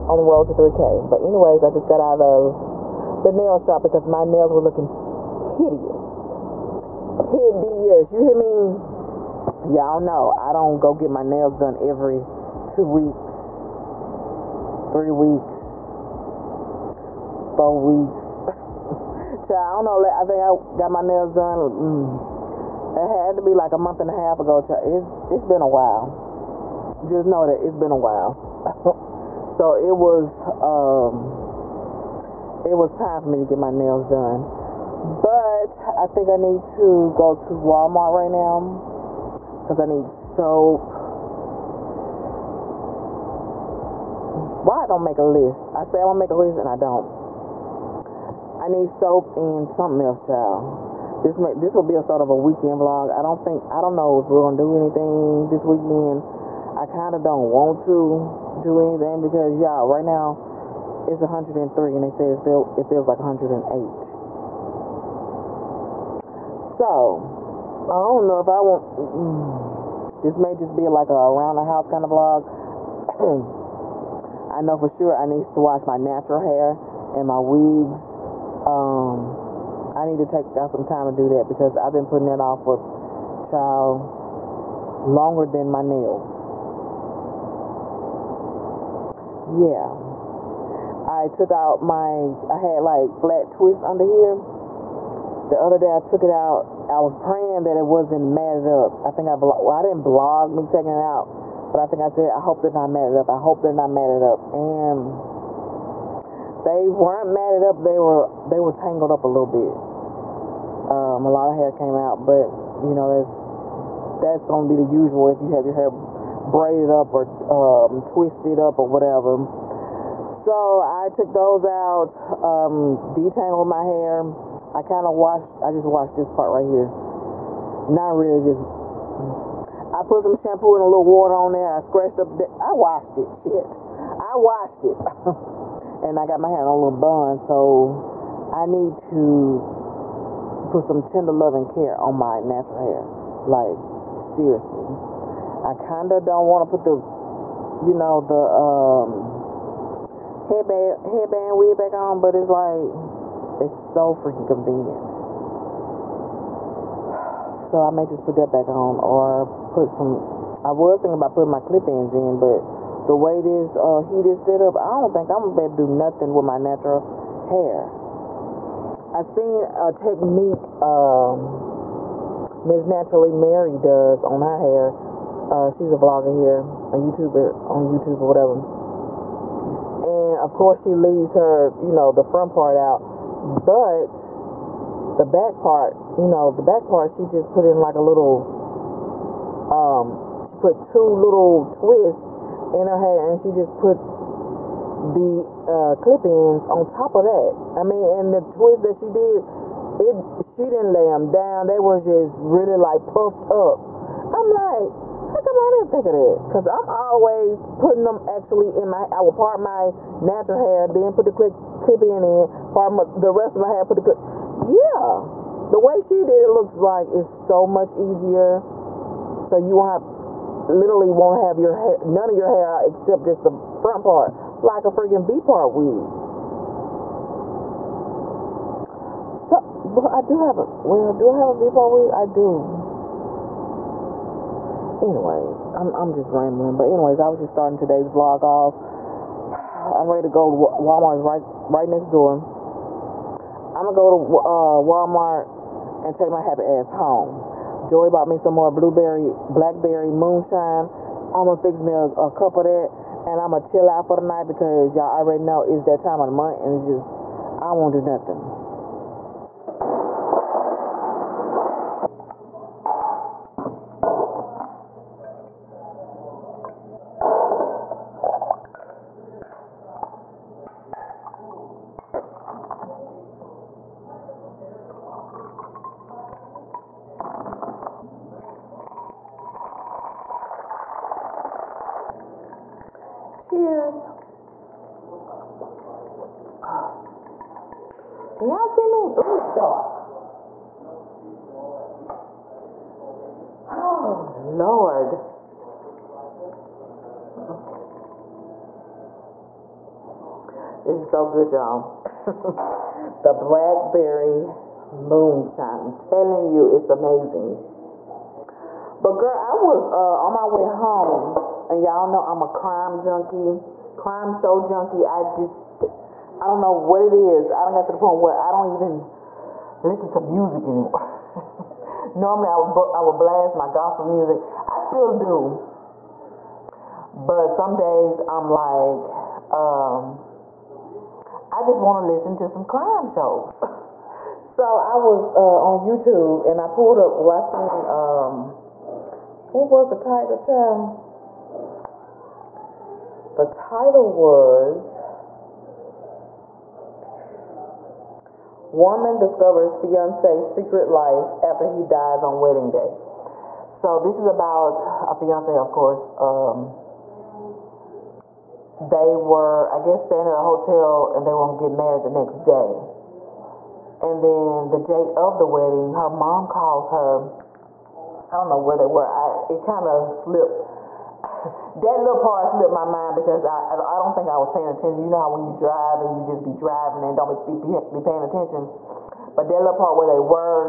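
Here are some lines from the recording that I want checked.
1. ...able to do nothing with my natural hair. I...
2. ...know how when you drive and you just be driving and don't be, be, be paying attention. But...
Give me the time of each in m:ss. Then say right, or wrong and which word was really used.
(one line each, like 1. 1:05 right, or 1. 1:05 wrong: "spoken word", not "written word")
1. 2:45 right
2. 6:15 right.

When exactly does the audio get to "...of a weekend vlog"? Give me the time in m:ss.
0:52.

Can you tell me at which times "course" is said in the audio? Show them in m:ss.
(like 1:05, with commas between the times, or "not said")
3:00, 5:55.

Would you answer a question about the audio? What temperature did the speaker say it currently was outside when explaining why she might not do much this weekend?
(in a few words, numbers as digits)
103.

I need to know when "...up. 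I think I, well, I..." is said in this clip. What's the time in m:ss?
1:38.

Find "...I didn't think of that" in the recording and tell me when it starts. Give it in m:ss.
3:25.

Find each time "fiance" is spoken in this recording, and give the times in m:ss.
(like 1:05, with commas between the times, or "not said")
5:49, 5:55.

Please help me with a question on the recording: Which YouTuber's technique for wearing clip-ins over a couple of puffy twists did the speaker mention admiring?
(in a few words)
Naturally Mary.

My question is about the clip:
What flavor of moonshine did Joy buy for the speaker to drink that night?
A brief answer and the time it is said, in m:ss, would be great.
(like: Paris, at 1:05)
blueberry, blackberry, at 4:08.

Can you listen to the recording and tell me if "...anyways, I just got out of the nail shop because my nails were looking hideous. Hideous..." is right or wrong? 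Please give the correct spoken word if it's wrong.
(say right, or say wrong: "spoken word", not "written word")
right.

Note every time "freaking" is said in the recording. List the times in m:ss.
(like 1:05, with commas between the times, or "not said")
2:34, 3:44.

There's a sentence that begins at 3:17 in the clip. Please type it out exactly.
I mean, and the twist that she did, it she didn't lay them down.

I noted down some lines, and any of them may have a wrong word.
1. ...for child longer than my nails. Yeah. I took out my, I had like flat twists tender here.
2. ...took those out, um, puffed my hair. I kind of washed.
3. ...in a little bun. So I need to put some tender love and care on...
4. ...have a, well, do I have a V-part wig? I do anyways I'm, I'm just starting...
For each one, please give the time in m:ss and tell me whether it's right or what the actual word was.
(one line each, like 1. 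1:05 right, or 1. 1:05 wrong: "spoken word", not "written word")
1. 1:22 wrong: "under", not "tender"
2. 2:01 wrong: "detangled", not "puffed"
3. 2:16 right
4. 3:50 wrong: "rambling", not "starting".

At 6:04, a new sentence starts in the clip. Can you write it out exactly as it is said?
And then the day of the wedding, her mom calls her.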